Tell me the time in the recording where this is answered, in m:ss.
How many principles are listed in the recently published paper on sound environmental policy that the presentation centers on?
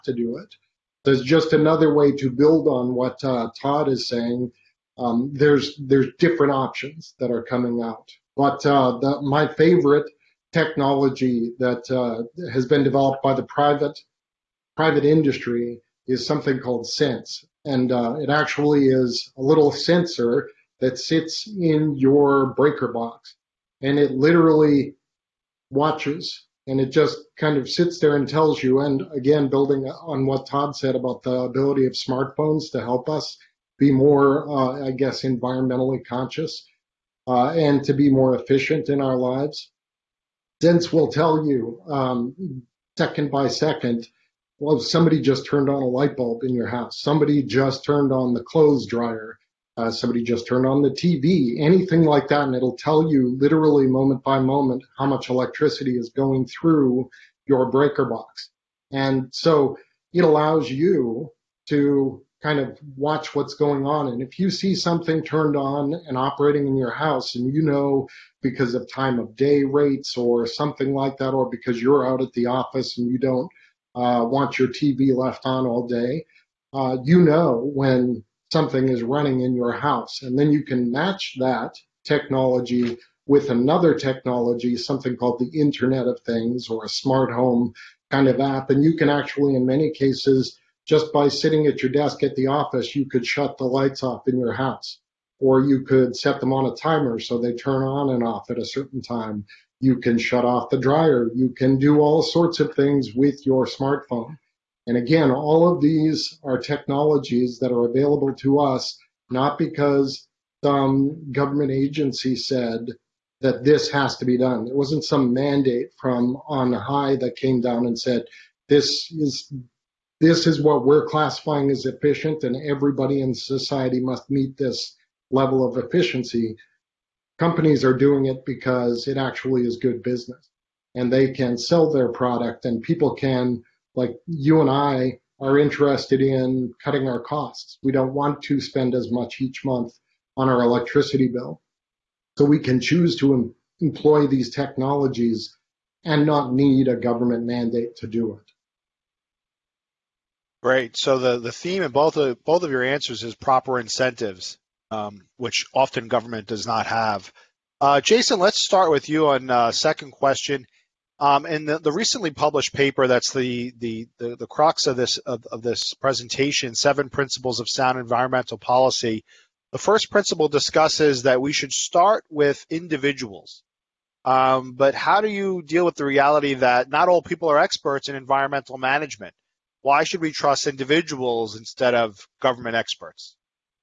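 2:46.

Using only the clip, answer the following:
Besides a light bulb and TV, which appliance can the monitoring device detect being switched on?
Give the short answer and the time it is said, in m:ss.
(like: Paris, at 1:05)
clothes dryer, at 0:48.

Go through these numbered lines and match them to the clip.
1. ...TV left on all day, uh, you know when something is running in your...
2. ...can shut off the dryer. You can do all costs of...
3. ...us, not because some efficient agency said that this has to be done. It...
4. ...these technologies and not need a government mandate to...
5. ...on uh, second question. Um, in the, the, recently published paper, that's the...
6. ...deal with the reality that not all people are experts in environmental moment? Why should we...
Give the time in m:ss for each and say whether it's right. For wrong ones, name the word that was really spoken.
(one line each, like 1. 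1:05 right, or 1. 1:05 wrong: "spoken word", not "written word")
1. 1:14 right
2. 1:39 wrong: "sorts", not "costs"
3. 1:48 wrong: "government", not "efficient"
4. 2:24 right
5. 2:39 right
6. 2:55 wrong: "management", not "moment".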